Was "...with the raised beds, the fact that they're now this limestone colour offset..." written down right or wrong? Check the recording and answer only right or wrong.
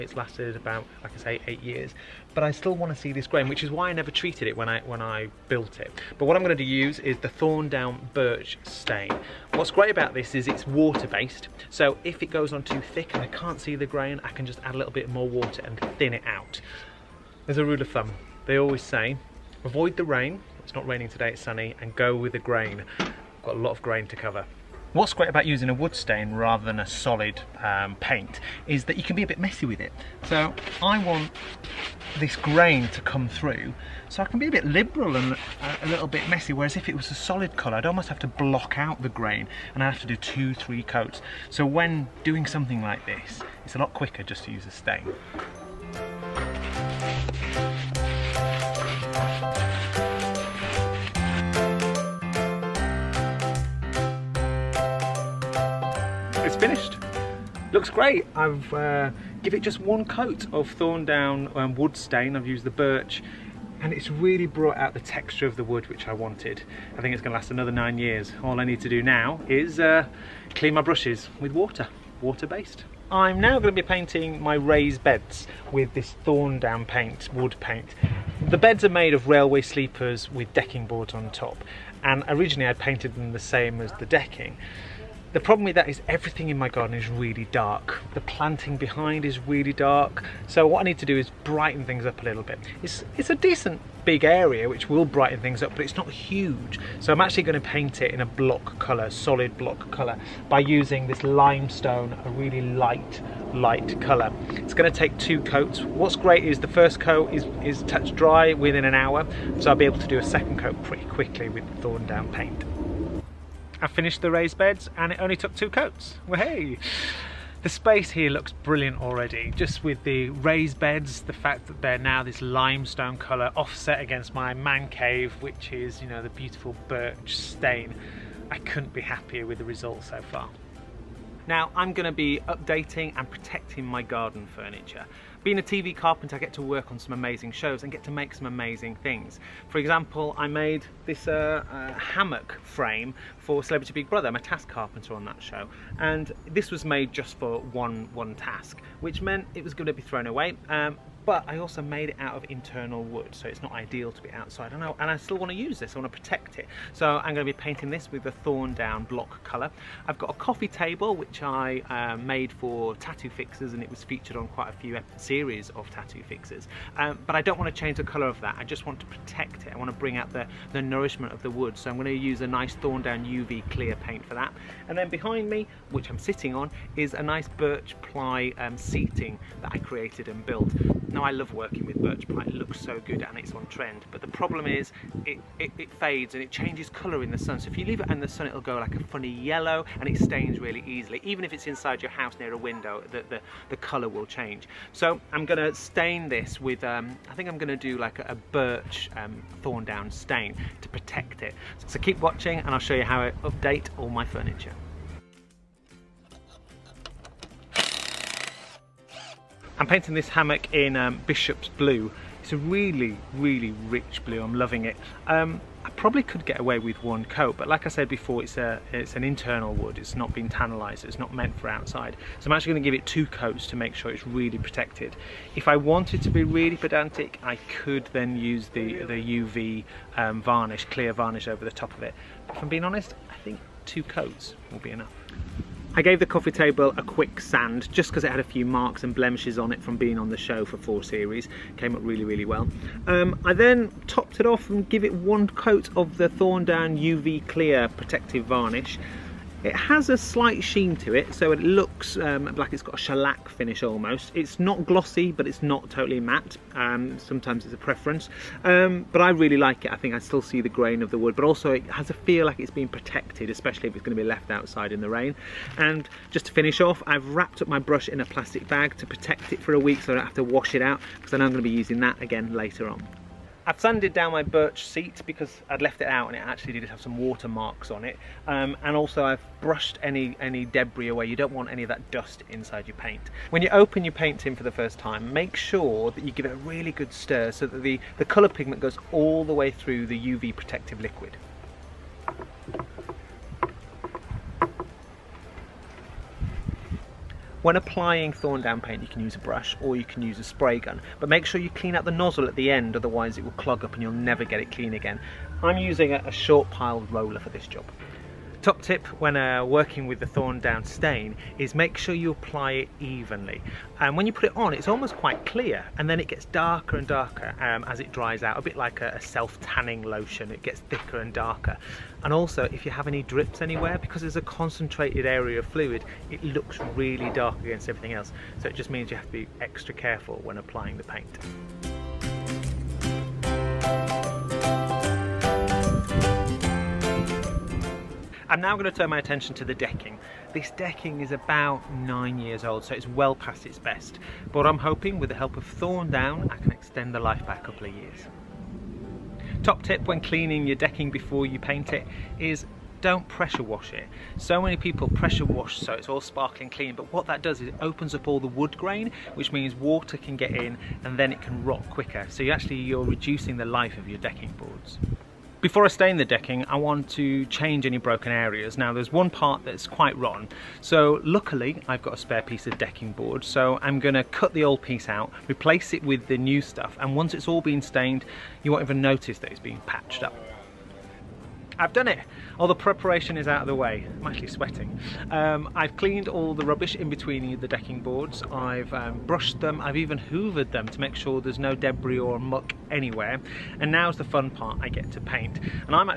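right.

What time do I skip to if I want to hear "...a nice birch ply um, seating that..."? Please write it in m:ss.
2:57.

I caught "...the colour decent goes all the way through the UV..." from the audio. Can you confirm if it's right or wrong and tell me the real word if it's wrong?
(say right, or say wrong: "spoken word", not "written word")
wrong: "pigment", not "decent".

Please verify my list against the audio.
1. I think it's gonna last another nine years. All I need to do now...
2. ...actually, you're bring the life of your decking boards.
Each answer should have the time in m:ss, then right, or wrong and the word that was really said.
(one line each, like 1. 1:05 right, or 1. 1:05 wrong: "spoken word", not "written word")
1. 1:06 right
2. 6:02 wrong: "reducing", not "bring".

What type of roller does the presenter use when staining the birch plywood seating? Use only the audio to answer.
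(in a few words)
Short pile roller.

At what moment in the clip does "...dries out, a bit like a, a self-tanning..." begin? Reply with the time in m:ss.
5:18.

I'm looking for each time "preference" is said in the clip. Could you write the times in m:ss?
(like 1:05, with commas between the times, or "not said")
4:17.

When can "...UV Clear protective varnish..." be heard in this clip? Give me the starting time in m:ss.
4:06.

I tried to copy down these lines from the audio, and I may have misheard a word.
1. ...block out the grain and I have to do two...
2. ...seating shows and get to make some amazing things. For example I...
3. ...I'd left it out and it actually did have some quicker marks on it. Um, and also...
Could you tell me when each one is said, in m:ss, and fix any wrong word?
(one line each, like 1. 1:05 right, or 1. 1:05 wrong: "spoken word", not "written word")
1. 0:38 right
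2. 2:17 wrong: "amazing", not "seating"
3. 4:35 wrong: "water", not "quicker".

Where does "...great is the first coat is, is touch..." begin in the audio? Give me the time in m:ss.
1:46.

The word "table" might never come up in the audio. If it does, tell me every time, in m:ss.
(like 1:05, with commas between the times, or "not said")
2:40, 3:56.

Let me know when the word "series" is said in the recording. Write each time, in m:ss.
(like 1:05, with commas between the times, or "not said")
2:45, 4:01.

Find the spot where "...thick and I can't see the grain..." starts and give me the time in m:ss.
0:12.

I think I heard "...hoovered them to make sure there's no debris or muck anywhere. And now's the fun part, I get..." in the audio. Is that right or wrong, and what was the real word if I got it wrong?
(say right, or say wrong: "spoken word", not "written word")
right.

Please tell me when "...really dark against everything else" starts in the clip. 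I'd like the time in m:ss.
5:26.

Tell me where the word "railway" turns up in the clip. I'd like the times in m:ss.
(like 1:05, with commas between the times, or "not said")
1:19.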